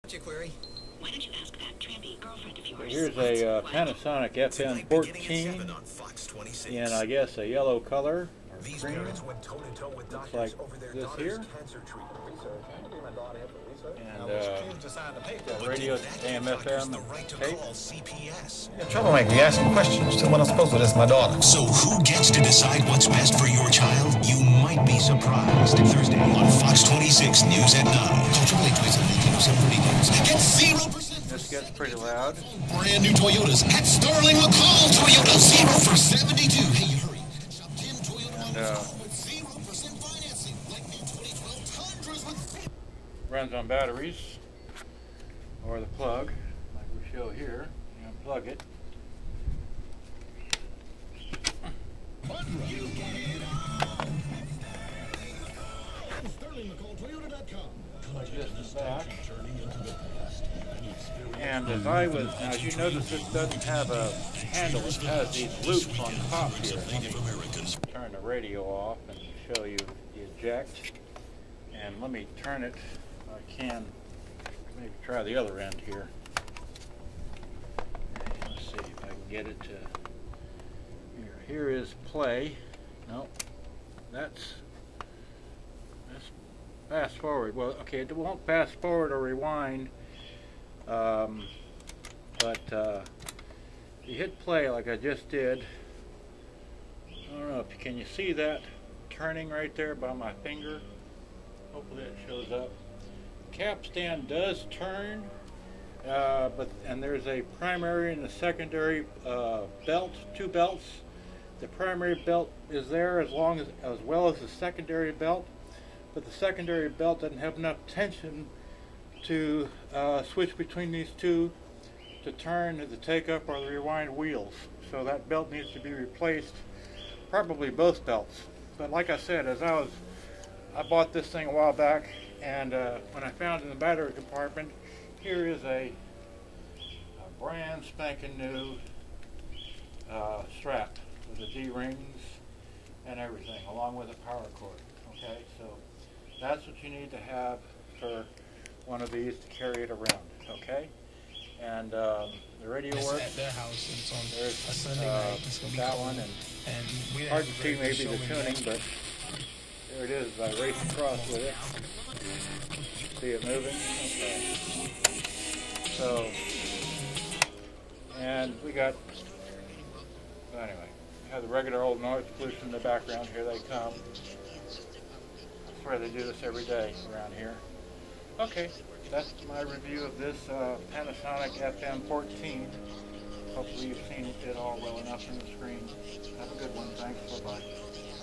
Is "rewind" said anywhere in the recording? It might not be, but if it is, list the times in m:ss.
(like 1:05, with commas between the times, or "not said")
1:29, 2:03.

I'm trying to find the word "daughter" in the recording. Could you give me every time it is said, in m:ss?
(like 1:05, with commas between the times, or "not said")
0:10, 0:21.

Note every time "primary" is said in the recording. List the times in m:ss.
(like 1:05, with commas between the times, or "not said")
1:47, 1:51.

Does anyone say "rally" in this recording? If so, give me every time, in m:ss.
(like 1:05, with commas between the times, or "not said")
not said.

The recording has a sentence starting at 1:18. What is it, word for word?
Let's see if I can get it to, here, here is play.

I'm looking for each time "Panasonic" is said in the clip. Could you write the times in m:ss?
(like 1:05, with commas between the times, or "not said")
0:03, 3:00.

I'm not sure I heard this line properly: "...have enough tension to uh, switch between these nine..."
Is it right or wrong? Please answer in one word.
wrong.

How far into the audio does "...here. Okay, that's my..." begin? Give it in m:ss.
2:57.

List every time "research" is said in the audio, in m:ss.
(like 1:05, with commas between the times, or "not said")
0:12.